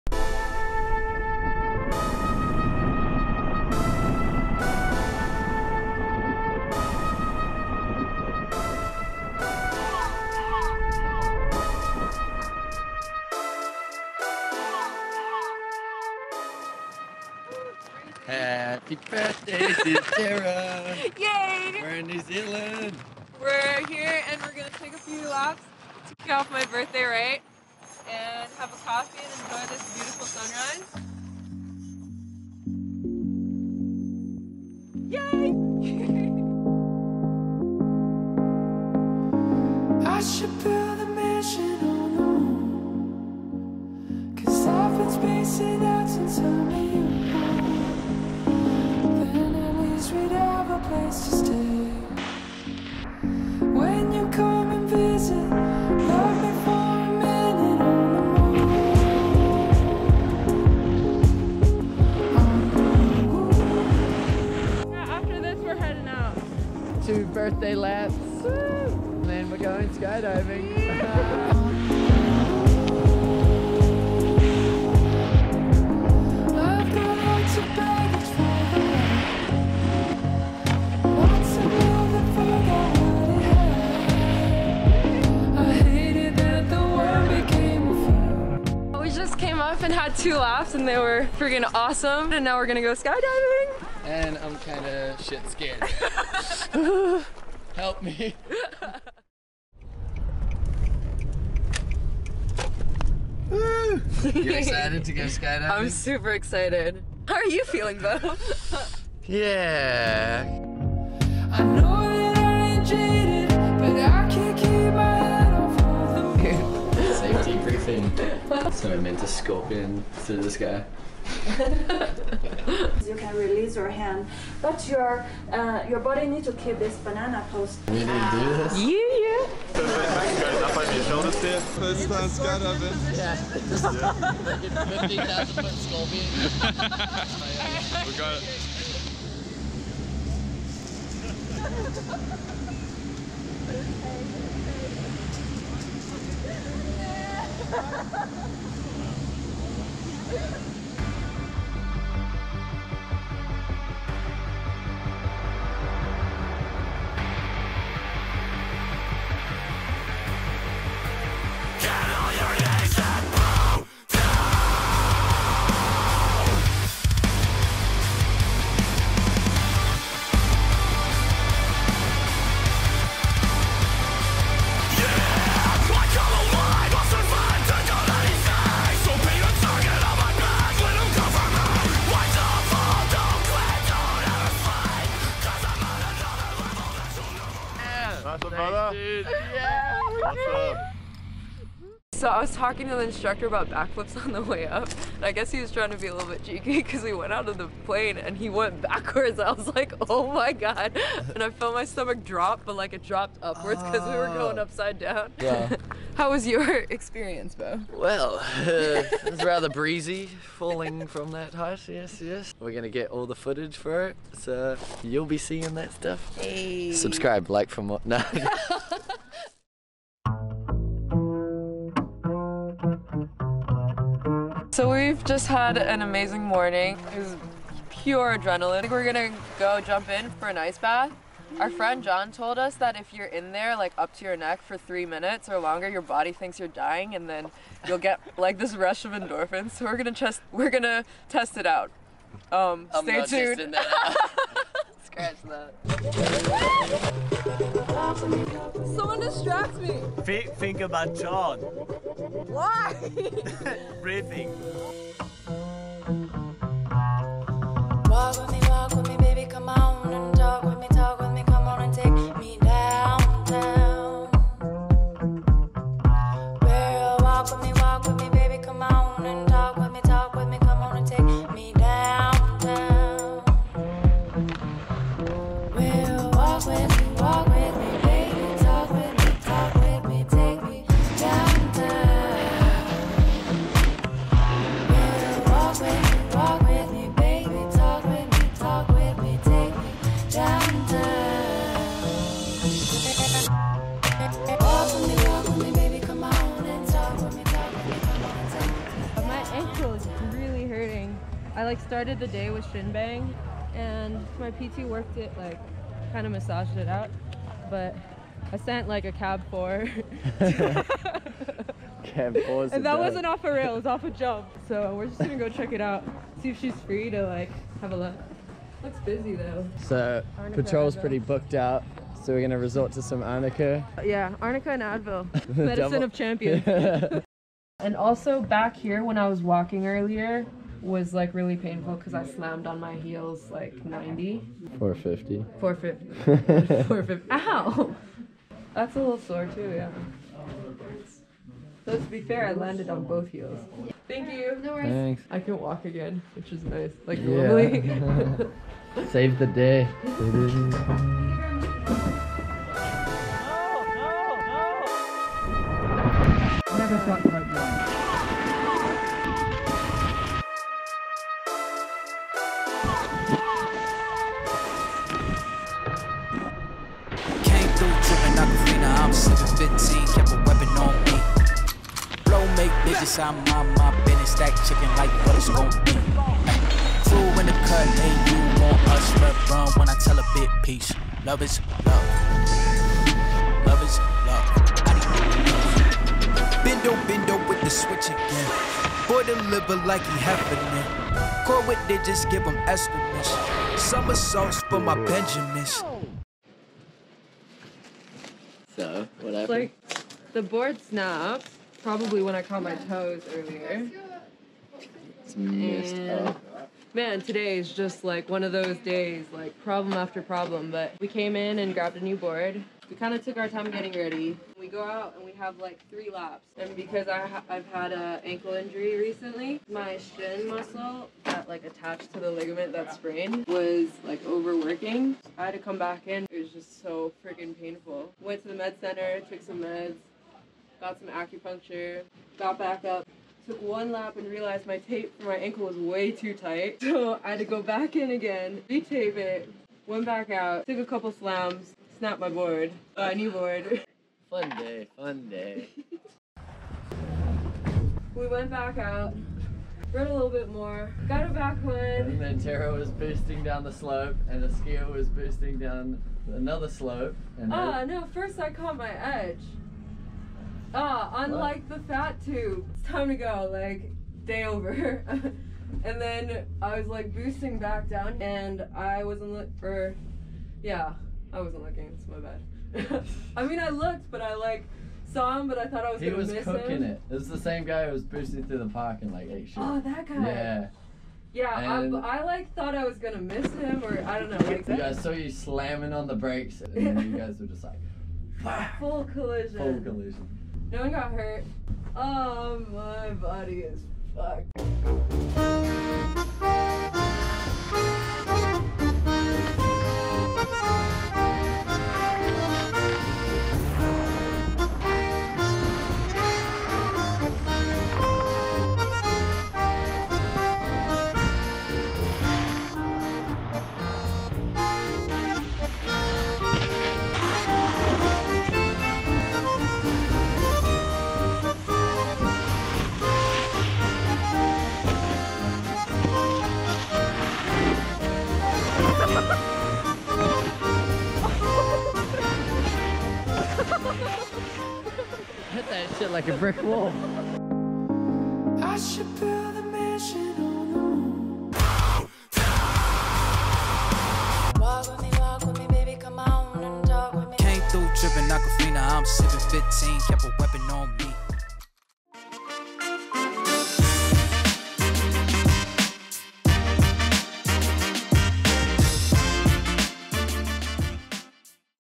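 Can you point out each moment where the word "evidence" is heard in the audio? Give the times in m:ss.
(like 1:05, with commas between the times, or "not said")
not said.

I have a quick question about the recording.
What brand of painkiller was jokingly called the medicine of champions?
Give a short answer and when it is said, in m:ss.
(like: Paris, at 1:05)
Advil, at 5:24.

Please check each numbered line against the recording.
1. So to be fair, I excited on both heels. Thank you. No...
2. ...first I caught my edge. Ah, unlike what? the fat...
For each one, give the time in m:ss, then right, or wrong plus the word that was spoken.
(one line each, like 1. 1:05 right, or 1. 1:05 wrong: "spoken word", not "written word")
1. 5:41 wrong: "landed", not "excited"
2. 7:38 right.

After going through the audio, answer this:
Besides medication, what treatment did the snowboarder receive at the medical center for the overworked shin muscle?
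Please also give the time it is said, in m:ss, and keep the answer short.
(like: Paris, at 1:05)
Acupuncture, at 7:11.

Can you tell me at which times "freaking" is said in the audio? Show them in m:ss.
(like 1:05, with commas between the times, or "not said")
1:31, 7:07.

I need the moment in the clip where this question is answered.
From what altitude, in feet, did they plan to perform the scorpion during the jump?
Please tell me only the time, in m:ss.
2:15.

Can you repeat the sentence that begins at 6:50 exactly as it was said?
But we came in and grabbed a new board.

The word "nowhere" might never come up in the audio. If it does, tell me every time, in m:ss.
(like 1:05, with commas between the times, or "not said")
not said.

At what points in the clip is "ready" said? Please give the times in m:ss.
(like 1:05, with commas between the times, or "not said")
6:53.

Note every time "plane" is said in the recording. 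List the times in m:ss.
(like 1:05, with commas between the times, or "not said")
3:17.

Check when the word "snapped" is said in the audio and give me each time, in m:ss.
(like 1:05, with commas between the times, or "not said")
6:40, 7:21.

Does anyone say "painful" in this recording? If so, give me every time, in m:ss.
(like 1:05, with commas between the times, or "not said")
5:31, 7:07.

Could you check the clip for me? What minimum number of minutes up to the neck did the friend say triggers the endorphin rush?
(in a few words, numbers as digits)
3.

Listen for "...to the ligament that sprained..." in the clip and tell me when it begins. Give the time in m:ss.
7:02.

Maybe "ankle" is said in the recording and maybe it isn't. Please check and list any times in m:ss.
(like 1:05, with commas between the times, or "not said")
6:58, 7:15.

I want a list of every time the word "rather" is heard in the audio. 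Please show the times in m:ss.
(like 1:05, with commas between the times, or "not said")
3:29.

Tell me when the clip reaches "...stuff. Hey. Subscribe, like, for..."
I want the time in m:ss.
3:35.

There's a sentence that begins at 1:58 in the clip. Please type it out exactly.
so I meant to scorpion through the sky.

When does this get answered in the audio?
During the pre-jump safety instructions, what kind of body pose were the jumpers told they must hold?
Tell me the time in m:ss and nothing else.
2:06.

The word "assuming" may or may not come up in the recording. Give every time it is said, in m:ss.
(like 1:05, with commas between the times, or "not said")
not said.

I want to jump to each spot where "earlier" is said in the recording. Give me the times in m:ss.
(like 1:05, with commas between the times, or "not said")
5:29, 6:43.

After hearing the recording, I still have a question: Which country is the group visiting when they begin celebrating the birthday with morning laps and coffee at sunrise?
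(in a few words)
New Zealand.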